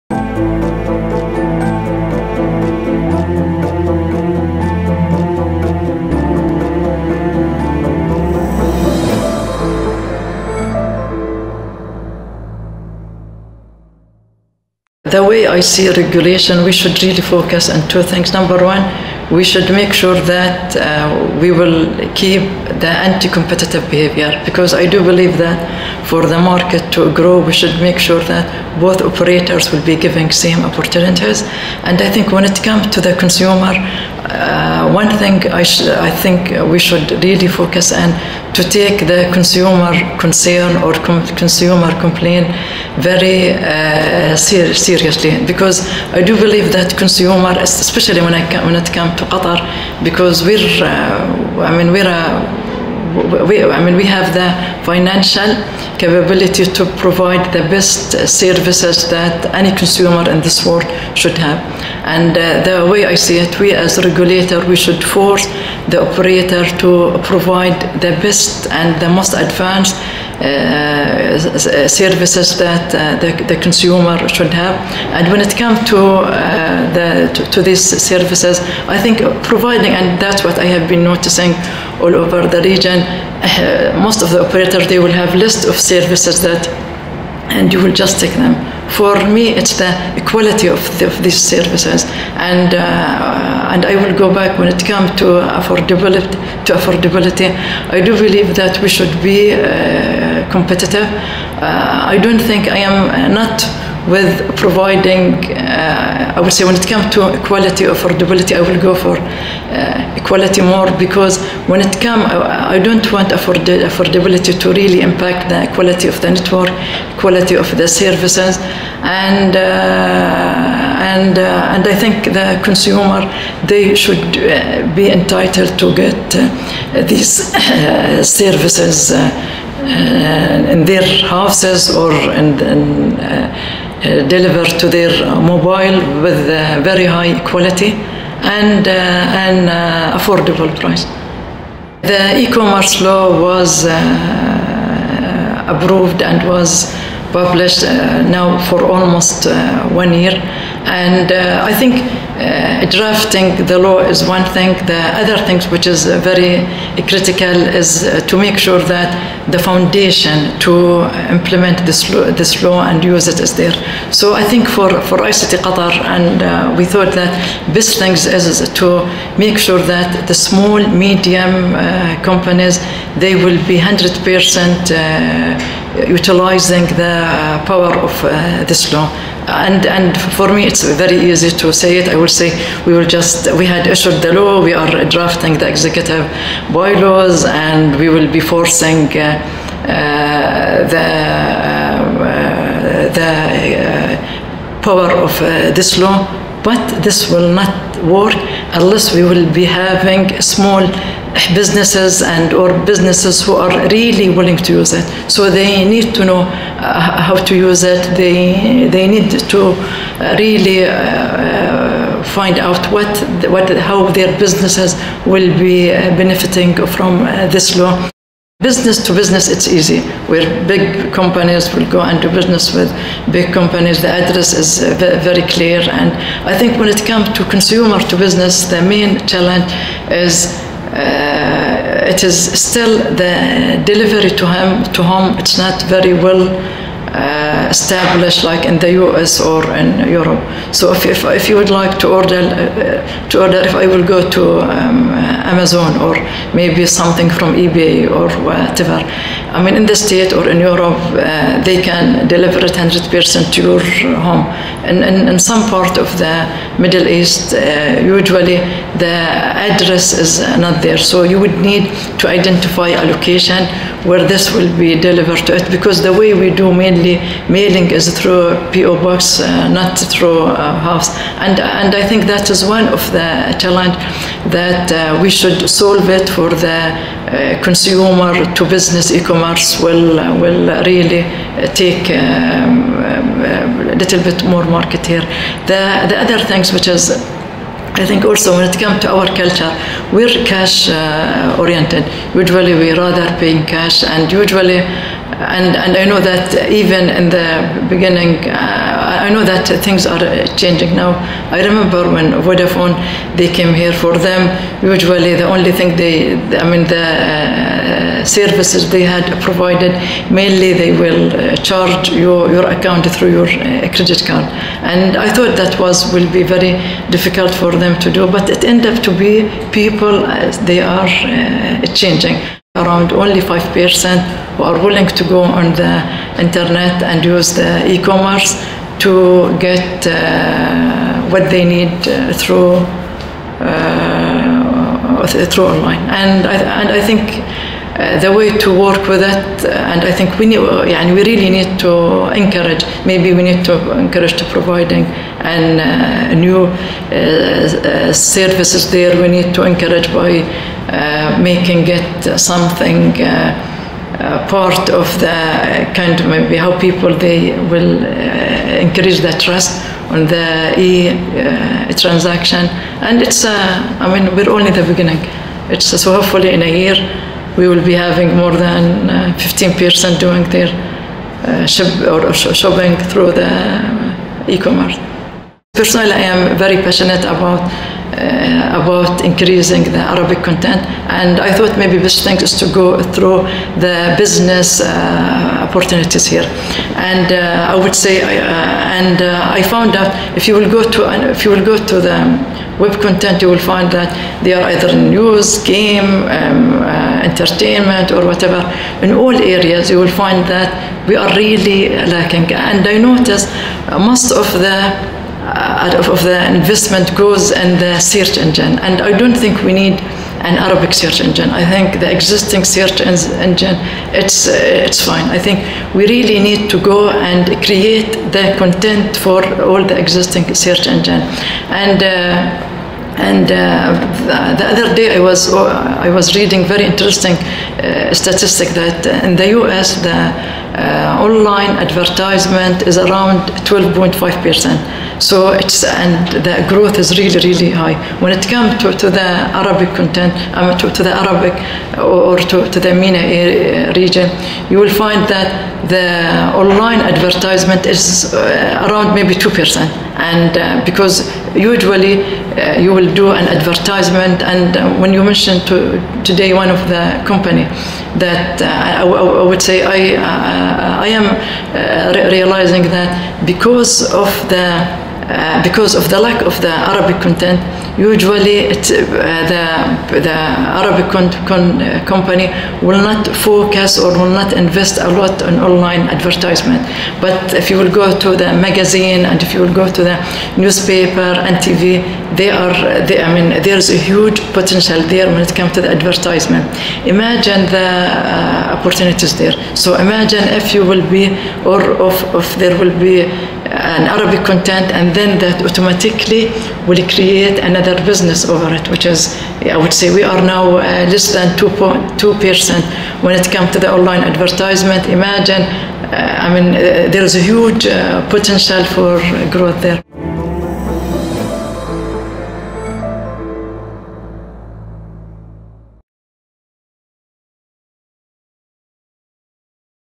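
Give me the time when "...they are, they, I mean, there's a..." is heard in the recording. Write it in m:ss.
8:02.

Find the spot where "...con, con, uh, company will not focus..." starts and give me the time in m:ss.
7:51.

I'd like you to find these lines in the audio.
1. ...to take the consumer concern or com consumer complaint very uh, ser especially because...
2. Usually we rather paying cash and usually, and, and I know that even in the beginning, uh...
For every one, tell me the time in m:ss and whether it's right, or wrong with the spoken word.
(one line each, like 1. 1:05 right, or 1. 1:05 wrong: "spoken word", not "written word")
1. 0:38 wrong: "seriously", not "especially"
2. 4:52 right.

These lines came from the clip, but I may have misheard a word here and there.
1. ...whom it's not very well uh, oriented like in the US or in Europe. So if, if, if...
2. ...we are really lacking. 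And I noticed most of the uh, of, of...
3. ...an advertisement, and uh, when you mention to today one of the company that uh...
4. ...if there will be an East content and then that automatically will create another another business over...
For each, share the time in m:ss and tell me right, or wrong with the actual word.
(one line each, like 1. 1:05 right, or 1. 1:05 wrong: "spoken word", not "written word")
1. 3:55 wrong: "established", not "oriented"
2. 6:41 right
3. 7:33 right
4. 8:12 wrong: "Arabic", not "East".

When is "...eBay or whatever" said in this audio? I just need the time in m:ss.
4:07.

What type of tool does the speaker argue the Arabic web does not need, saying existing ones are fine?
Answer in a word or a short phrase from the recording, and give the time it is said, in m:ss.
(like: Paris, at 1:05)
Arabic search engine, at 6:50.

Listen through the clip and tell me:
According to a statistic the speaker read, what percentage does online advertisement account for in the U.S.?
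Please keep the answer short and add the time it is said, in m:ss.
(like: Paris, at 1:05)
12.5%, at 7:13.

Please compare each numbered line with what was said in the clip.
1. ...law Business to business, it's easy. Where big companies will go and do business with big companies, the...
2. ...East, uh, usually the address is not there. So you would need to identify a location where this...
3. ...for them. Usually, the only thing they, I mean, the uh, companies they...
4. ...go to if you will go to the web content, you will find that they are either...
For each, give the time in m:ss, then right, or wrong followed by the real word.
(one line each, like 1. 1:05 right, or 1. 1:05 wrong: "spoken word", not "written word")
1. 3:37 right
2. 4:17 right
3. 5:03 wrong: "services", not "companies"
4. 6:30 right.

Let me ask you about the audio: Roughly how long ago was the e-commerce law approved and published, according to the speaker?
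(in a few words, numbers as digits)
Almost one year.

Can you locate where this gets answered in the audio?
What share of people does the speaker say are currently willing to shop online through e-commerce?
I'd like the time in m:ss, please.
5:23.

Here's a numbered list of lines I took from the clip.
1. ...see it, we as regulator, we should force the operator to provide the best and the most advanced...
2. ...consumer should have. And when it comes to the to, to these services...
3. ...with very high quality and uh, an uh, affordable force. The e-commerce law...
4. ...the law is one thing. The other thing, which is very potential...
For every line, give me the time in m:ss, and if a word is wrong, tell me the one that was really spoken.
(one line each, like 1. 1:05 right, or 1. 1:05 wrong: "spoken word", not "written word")
1. 1:03 right
2. 1:13 right
3. 2:16 wrong: "price", not "force"
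4. 2:33 wrong: "critical", not "potential".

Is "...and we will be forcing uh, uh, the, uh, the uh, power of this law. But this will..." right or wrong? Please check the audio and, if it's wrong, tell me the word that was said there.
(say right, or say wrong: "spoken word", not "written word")
right.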